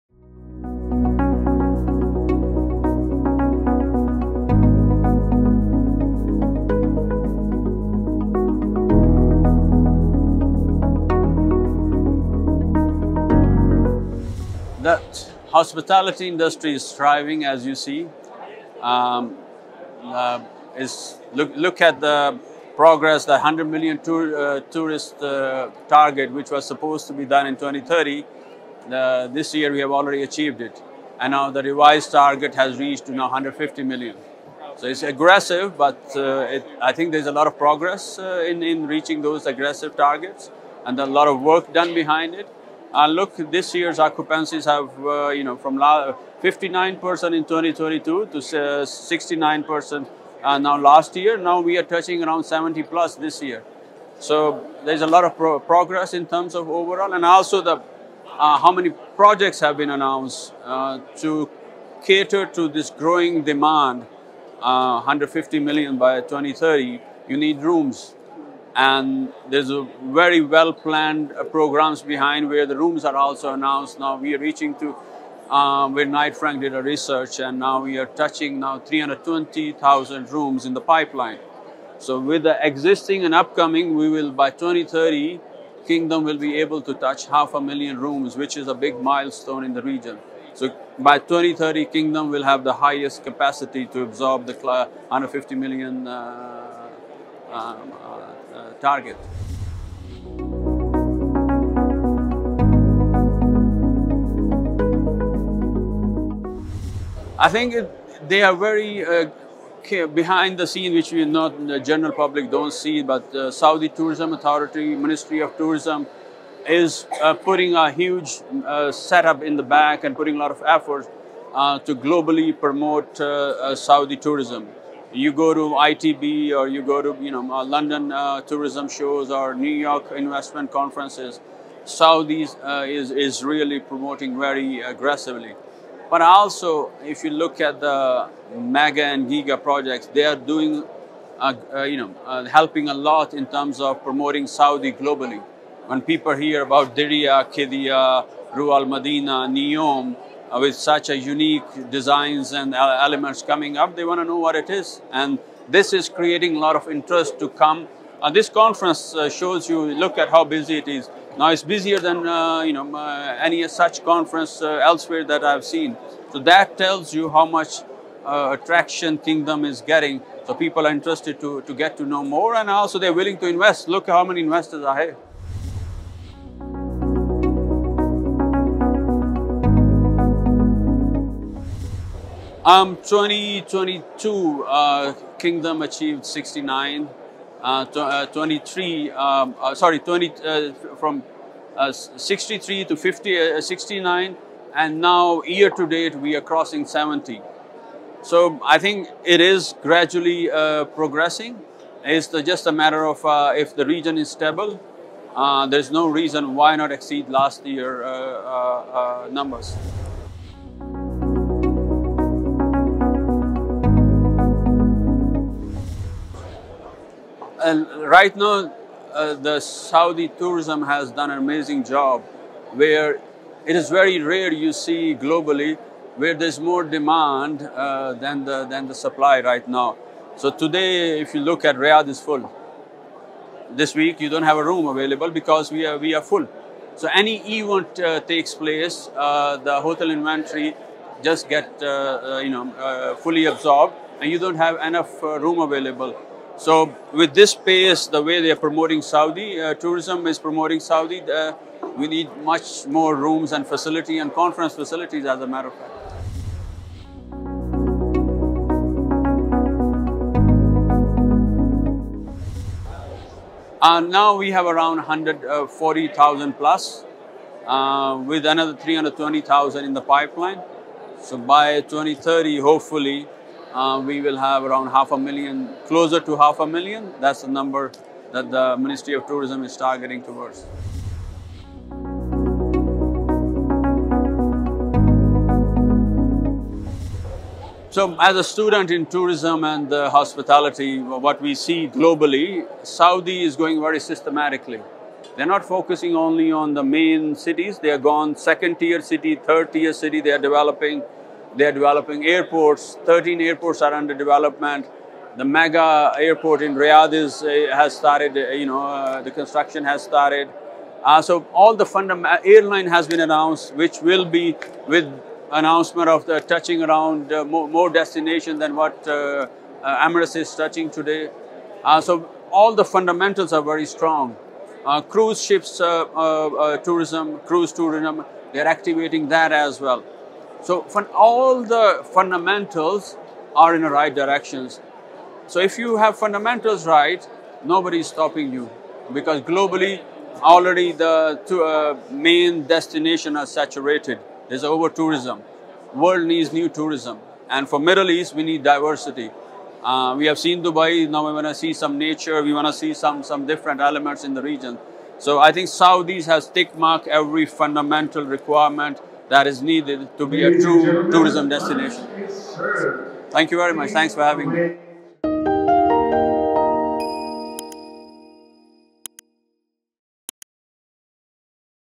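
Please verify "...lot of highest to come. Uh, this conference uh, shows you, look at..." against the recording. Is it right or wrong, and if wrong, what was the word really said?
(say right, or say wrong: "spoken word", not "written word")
wrong: "interest", not "highest".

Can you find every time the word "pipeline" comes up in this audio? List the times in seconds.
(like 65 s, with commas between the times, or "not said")
80 s, 270 s.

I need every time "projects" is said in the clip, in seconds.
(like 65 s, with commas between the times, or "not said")
59 s, 139 s.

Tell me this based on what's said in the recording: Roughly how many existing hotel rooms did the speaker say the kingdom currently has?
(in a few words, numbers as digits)
140,000.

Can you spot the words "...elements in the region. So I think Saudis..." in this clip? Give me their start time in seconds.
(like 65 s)
353 s.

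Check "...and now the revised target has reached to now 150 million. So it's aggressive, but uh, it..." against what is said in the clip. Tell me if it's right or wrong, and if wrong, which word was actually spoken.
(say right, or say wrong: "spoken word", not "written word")
right.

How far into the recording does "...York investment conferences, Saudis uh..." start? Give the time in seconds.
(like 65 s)
129 s.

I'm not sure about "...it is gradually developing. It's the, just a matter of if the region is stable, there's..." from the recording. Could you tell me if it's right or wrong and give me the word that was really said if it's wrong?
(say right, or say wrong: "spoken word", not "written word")
wrong: "progressing", not "developing".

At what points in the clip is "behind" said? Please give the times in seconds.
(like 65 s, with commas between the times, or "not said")
41 s, 72 s, 110 s.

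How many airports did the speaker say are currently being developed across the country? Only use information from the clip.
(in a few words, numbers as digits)
13.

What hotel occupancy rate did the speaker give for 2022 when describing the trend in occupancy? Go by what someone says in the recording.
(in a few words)
59%.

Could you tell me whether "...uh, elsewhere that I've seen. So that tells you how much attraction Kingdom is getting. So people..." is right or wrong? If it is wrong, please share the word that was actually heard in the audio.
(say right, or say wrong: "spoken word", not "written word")
right.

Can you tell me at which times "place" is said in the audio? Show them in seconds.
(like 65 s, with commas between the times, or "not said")
238 s.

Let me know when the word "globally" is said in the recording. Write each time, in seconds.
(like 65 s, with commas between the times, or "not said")
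121 s, 144 s, 225 s, 291 s, 339 s.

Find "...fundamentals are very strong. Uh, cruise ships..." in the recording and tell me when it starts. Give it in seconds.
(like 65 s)
322 s.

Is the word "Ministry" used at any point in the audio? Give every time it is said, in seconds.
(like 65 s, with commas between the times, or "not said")
114 s, 278 s.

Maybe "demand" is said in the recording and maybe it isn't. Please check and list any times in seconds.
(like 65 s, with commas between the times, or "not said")
63 s, 226 s.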